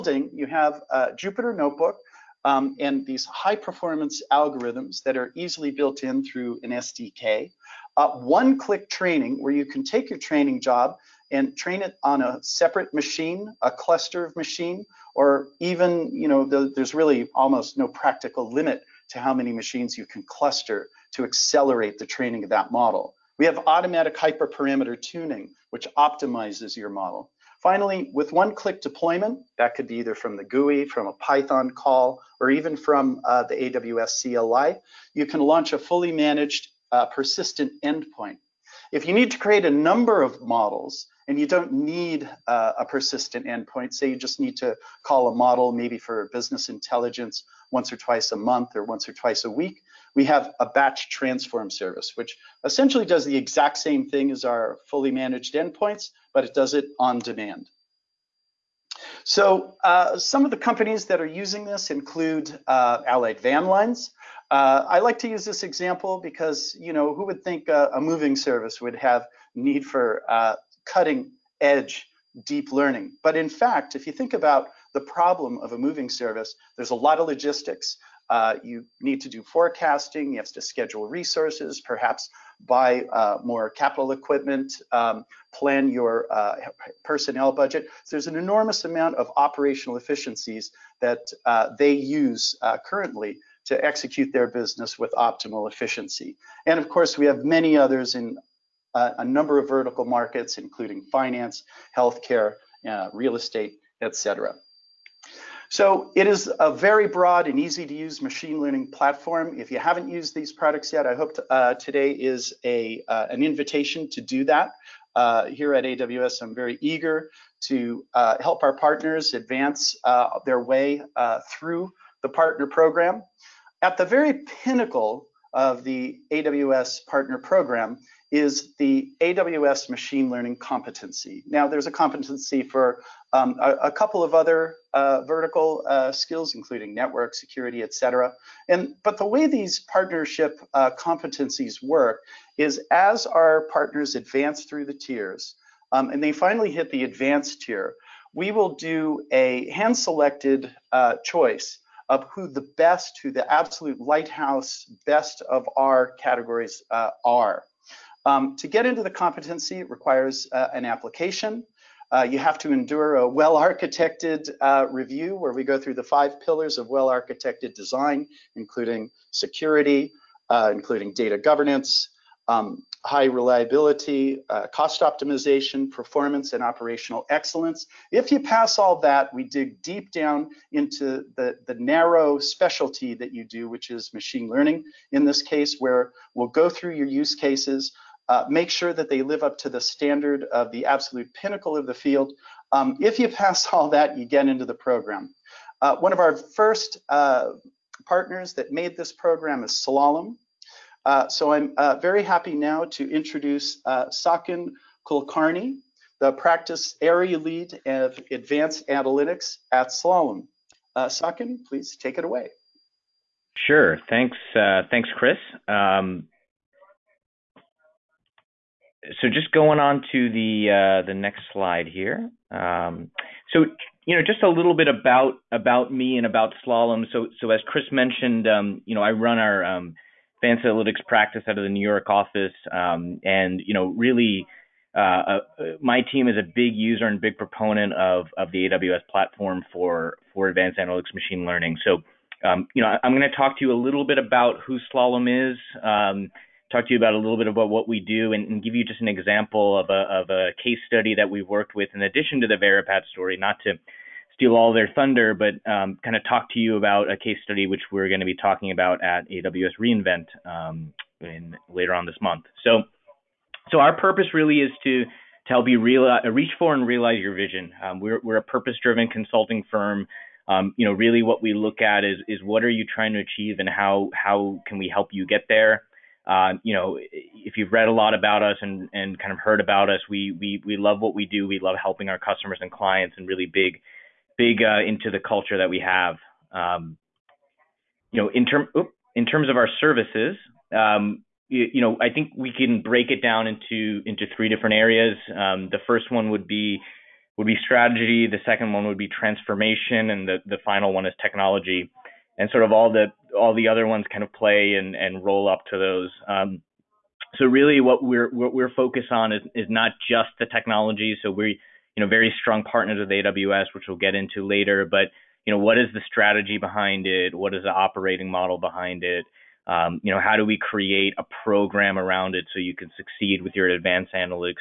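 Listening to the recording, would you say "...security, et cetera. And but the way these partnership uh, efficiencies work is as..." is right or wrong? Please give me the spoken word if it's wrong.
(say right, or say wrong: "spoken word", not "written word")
wrong: "competencies", not "efficiencies".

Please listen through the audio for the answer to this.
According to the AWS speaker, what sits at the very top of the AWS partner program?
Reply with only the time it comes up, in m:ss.
2:09.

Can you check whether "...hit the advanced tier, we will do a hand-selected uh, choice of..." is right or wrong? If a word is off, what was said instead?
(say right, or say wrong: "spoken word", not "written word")
right.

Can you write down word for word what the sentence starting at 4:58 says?
The second one would be transformation.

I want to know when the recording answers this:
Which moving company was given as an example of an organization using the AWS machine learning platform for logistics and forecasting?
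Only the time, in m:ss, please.
1:03.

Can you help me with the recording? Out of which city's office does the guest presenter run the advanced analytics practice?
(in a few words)
New York.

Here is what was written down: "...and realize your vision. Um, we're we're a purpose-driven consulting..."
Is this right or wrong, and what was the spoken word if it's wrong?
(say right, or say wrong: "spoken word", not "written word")
right.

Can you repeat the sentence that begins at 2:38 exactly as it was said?
Um, to get into the competency, requires uh, an application.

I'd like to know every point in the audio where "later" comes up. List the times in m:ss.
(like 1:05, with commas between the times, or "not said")
4:21, 5:14.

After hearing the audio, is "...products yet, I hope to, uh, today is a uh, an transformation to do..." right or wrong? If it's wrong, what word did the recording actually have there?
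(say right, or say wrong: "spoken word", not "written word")
wrong: "invitation", not "transformation".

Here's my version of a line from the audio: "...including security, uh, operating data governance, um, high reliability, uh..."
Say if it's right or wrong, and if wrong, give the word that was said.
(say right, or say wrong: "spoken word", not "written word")
wrong: "including", not "operating".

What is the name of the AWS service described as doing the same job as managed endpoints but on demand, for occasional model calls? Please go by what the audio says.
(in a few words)
batch transform.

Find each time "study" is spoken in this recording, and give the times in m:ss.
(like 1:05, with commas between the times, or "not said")
4:10, 4:17.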